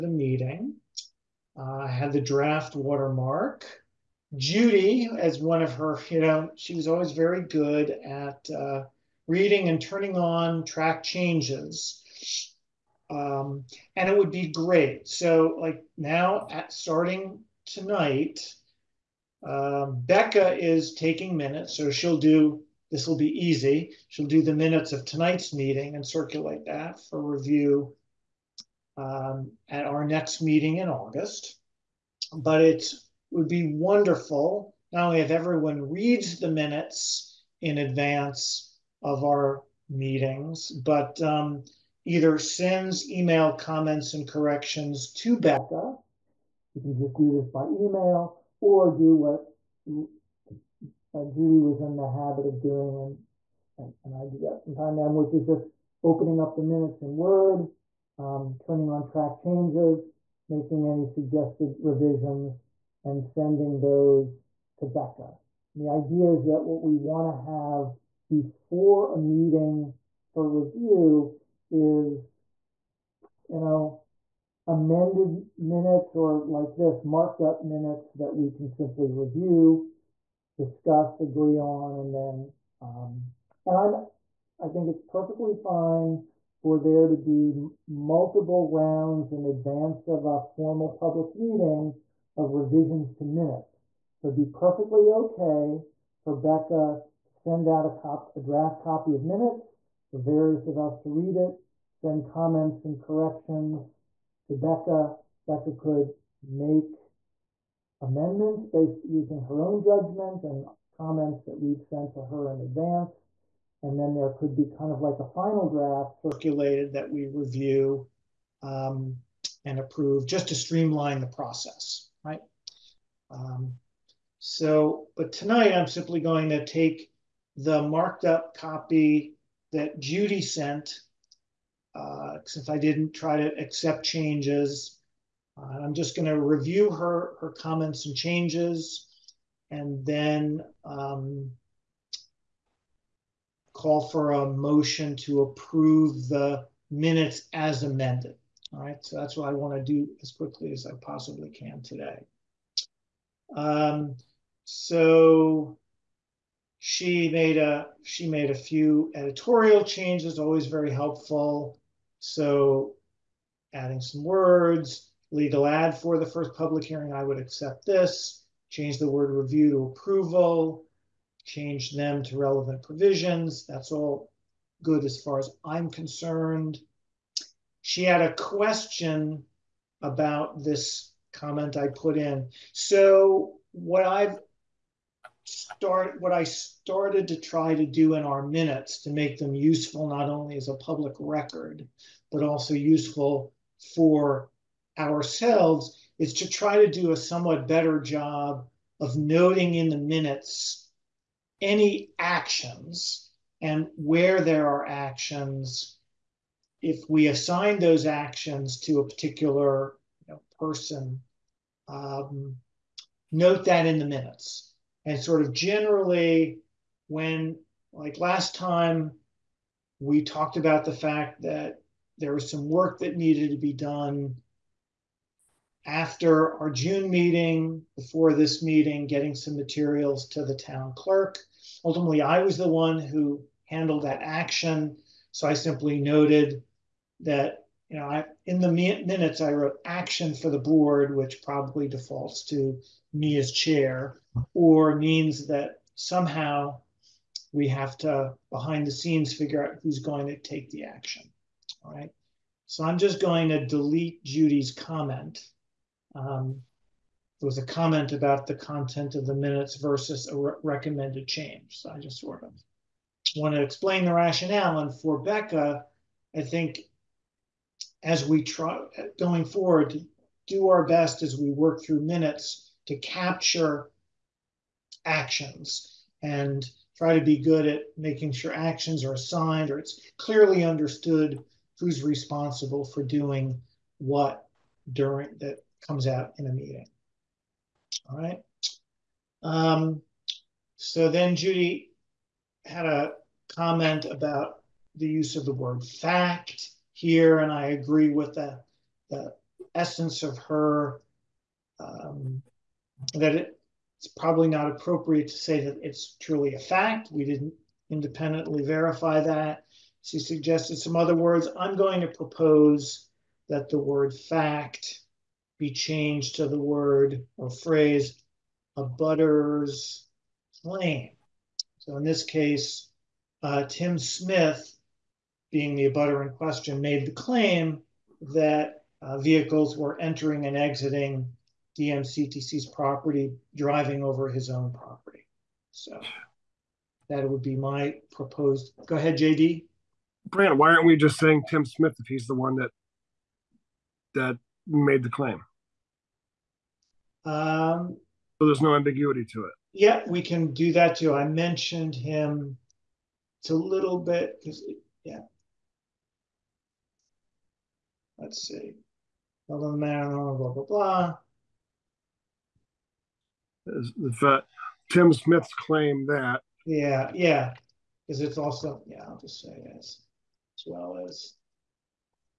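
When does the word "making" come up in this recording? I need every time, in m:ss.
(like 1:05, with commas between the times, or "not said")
1:00, 4:37.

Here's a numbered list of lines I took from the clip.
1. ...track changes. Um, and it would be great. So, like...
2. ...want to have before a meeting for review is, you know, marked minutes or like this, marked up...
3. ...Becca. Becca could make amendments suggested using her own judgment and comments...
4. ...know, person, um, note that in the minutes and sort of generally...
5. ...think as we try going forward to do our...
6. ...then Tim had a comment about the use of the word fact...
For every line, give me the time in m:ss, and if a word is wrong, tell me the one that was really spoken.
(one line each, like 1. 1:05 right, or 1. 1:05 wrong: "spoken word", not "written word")
1. 0:10 right
2. 1:06 wrong: "amended", not "marked"
3. 1:44 wrong: "based", not "suggested"
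4. 3:30 right
5. 4:26 right
6. 4:51 wrong: "Judy", not "Tim".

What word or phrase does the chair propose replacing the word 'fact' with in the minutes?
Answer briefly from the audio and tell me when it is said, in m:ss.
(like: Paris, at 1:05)
abutter's claim, at 5:18.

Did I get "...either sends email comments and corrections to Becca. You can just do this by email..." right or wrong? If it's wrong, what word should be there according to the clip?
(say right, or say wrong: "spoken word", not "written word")
right.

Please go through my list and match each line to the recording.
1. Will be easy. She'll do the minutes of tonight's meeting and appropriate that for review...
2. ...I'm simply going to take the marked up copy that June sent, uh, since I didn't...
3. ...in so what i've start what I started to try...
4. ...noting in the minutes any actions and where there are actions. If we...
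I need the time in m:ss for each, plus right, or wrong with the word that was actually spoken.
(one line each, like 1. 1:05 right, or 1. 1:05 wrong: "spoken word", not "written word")
1. 0:23 wrong: "circulate", not "appropriate"
2. 2:05 wrong: "Judy", not "June"
3. 3:02 right
4. 3:19 right.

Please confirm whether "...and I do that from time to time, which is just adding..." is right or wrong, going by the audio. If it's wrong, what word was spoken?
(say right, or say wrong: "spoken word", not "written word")
wrong: "opening", not "adding".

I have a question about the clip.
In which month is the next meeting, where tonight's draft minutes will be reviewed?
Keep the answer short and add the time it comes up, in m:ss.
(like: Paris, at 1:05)
August, at 0:30.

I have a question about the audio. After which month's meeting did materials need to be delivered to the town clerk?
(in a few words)
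June.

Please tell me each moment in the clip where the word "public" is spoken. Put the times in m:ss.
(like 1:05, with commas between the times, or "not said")
1:30, 2:46, 3:10.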